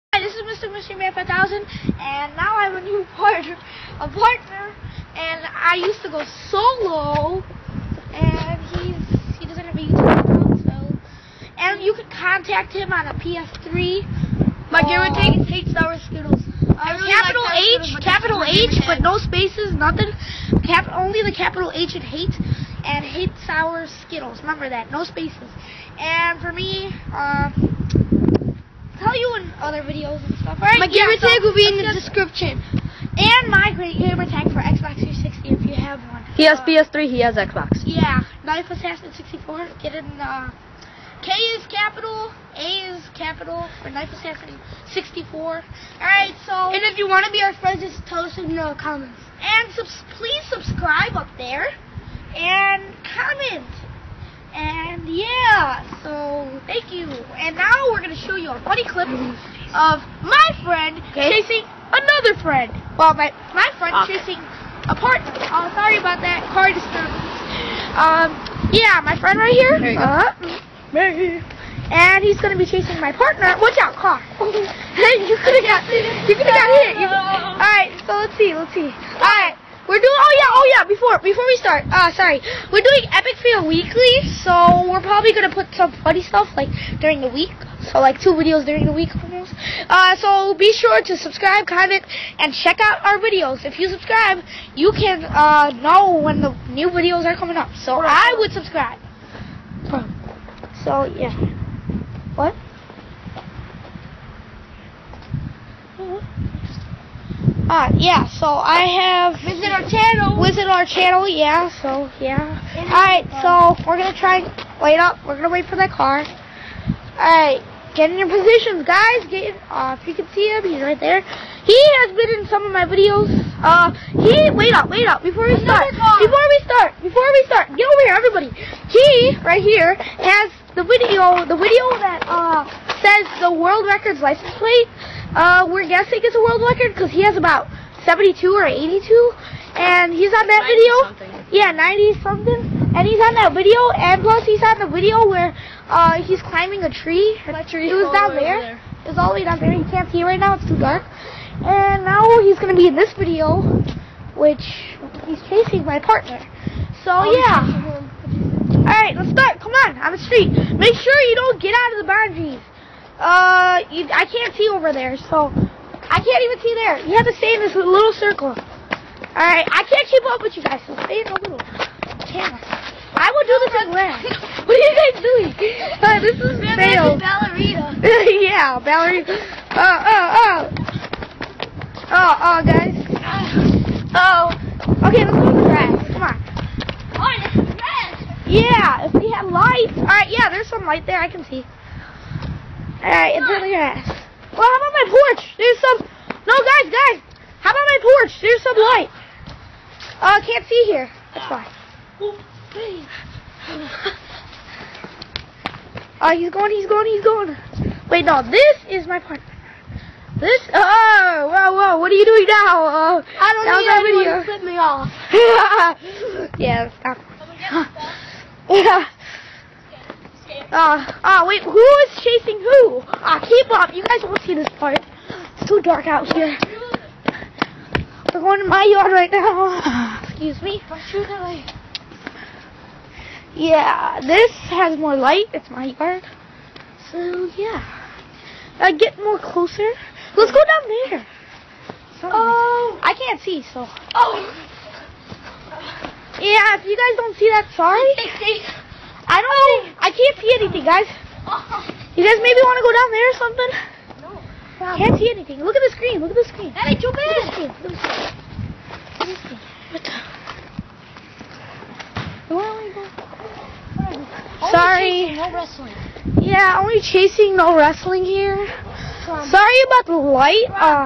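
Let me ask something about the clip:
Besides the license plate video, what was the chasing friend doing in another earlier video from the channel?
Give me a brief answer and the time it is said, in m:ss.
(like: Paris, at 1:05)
Climbing a tree, at 2:26.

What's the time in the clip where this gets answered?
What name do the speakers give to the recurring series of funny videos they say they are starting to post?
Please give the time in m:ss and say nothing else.
1:23.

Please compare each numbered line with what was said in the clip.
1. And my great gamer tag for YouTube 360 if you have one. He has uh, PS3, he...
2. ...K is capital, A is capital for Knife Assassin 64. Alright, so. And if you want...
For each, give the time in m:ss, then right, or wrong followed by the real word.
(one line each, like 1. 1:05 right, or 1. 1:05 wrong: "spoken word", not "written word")
1. 0:33 wrong: "Xbox", not "YouTube"
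2. 0:41 right.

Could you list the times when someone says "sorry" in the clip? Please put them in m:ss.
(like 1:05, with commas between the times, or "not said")
1:05, 1:22, 4:07, 4:24, 4:29.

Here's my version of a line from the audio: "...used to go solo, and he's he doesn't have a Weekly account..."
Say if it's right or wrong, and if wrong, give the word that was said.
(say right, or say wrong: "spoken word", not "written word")
wrong: "YouTube", not "Weekly".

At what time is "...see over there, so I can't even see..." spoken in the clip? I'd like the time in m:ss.
2:44.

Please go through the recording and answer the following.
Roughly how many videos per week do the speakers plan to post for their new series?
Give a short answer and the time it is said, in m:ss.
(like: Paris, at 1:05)
2, at 1:28.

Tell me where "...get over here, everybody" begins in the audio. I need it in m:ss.
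2:07.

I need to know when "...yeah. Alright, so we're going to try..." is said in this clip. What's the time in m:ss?
1:52.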